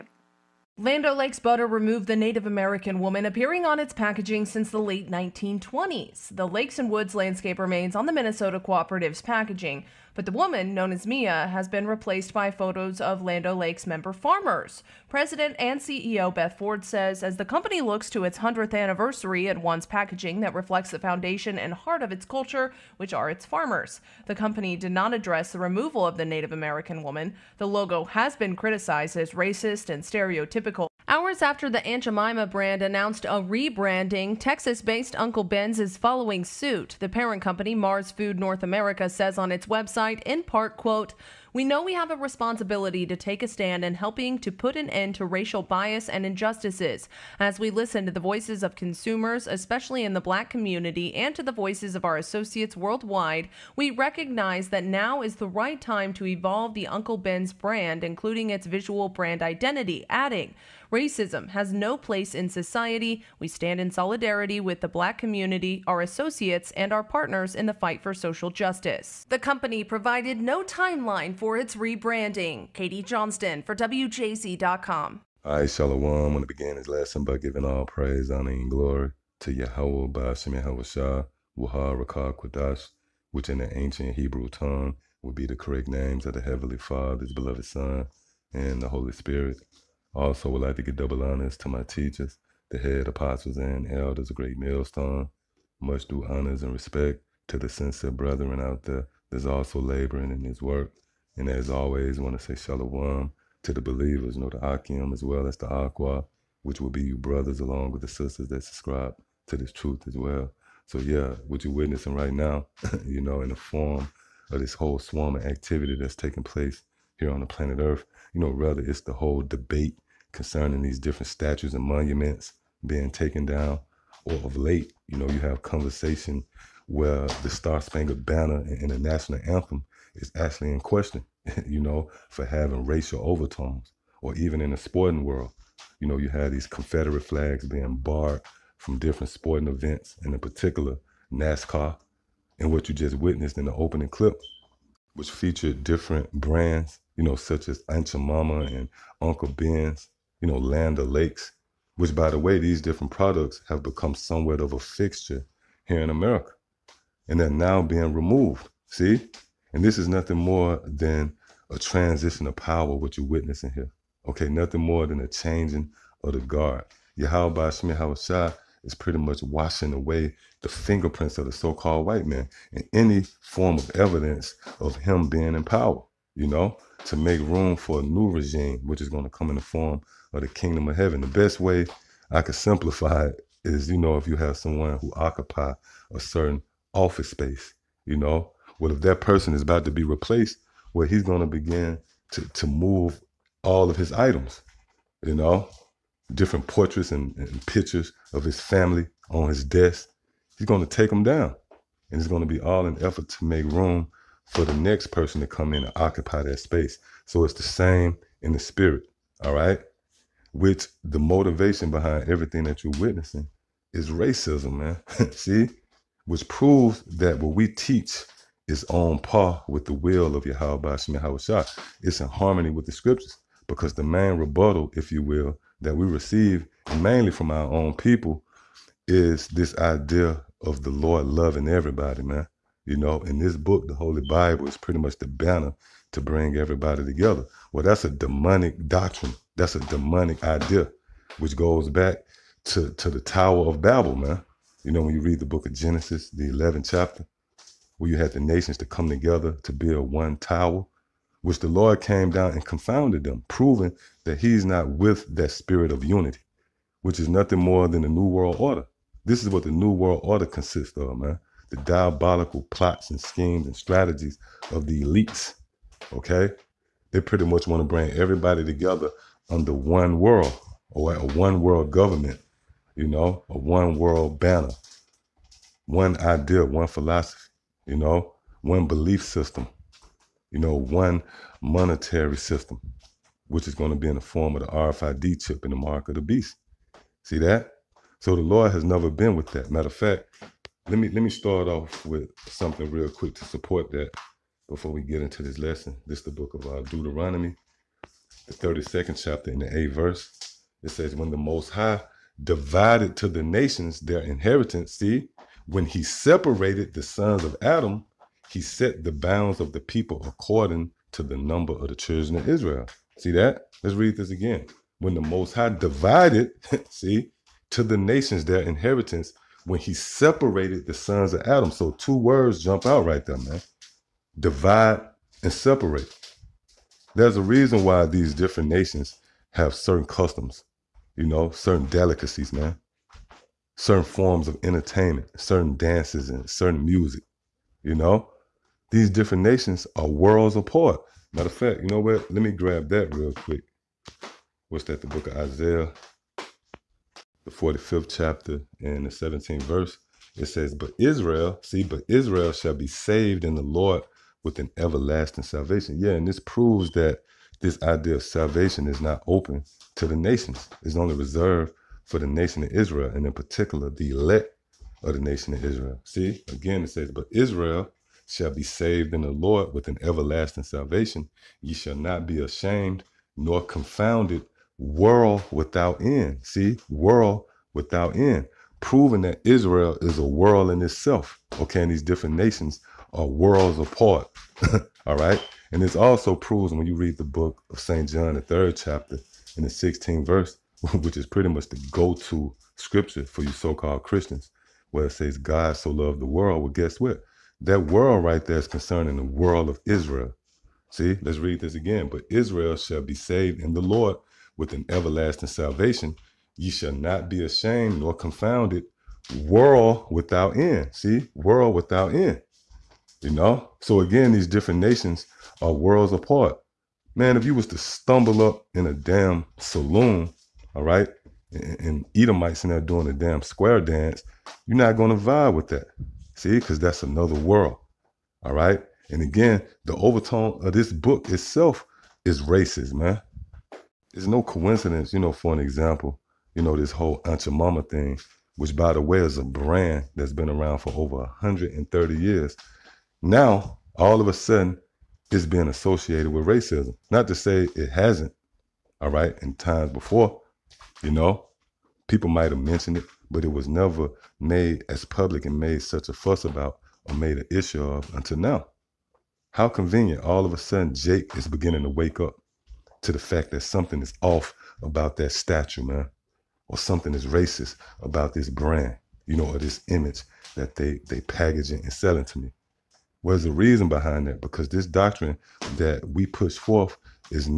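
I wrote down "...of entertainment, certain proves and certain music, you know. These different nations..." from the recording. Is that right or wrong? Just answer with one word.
wrong.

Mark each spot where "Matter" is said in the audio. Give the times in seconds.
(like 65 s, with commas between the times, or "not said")
289 s, 341 s.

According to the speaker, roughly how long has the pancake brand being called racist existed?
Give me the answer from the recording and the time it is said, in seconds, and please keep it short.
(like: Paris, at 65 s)
over 130 years, at 440 s.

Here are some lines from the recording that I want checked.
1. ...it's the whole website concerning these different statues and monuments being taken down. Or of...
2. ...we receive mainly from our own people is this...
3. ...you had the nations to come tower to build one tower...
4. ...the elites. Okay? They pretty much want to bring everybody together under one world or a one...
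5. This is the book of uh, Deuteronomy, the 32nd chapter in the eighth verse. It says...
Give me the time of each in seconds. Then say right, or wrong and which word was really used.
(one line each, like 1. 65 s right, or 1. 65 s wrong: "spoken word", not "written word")
1. 118 s wrong: "debate", not "website"
2. 225 s right
3. 248 s wrong: "together", not "tower"
4. 264 s right
5. 296 s right.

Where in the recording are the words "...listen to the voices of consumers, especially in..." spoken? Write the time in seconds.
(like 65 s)
47 s.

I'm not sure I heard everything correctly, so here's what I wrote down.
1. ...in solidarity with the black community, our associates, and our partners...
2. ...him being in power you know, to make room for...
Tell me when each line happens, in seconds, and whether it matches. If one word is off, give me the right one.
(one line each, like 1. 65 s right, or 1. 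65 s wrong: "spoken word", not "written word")
1. 63 s right
2. 174 s right.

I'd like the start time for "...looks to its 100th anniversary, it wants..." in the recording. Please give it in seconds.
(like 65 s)
17 s.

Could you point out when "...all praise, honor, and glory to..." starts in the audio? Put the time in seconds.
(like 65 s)
77 s.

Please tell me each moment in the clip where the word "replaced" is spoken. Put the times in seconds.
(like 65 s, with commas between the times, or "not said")
11 s, 190 s.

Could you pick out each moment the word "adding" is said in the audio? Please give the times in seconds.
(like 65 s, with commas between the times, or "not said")
60 s.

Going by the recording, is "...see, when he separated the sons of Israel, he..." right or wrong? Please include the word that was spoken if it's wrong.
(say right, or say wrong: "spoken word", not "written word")
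wrong: "Adam", not "Israel".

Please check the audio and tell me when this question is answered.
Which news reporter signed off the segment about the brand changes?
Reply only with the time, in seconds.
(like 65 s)
72 s.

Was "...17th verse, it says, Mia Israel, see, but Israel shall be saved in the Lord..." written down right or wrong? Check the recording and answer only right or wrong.
wrong.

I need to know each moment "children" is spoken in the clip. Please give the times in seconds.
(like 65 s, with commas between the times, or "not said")
311 s.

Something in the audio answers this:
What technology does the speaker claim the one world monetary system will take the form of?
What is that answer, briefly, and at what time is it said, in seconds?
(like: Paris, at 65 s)
RFID chip, at 284 s.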